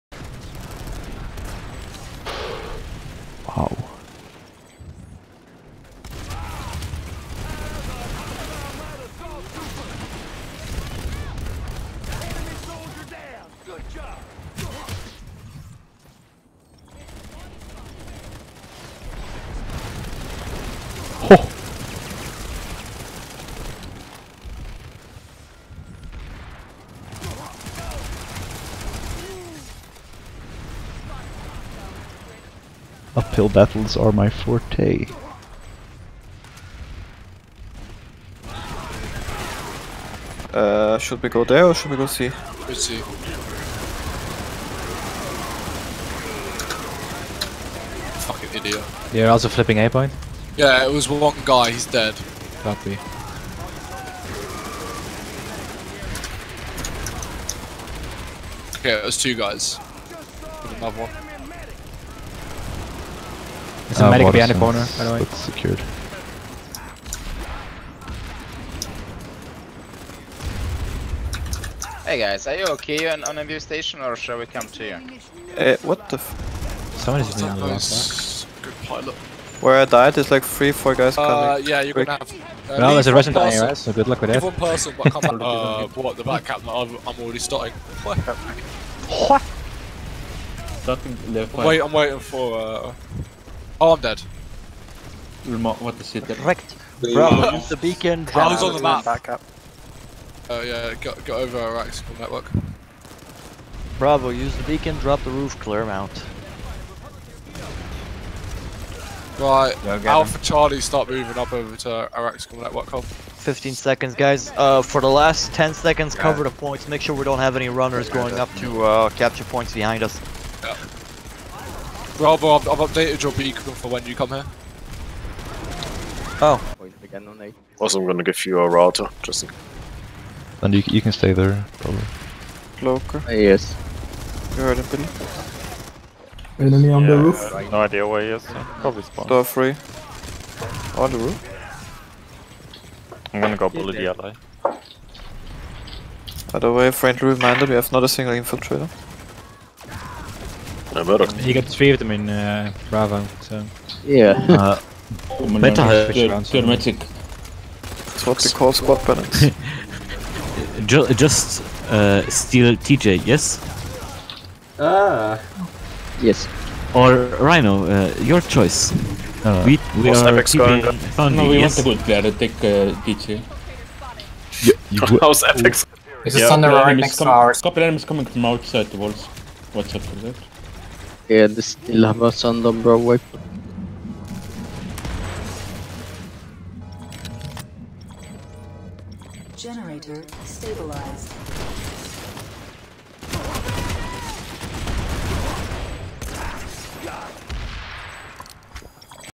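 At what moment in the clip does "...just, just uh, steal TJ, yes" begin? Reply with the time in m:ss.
2:40.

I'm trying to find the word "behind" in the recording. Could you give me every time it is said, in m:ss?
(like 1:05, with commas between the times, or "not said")
1:04, 1:59.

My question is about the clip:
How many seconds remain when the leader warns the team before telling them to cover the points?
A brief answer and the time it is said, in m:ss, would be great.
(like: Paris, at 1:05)
15, at 1:53.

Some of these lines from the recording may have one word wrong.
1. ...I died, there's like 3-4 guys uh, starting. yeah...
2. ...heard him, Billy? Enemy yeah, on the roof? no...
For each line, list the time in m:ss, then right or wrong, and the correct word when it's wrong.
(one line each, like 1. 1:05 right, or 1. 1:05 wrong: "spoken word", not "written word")
1. 1:19 wrong: "coming", not "starting"
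2. 2:14 right.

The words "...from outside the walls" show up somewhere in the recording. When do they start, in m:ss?
2:58.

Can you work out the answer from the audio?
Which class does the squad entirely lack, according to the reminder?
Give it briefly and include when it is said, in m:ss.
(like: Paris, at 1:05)
infiltrator, at 2:28.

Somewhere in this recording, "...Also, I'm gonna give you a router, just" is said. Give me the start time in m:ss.
2:07.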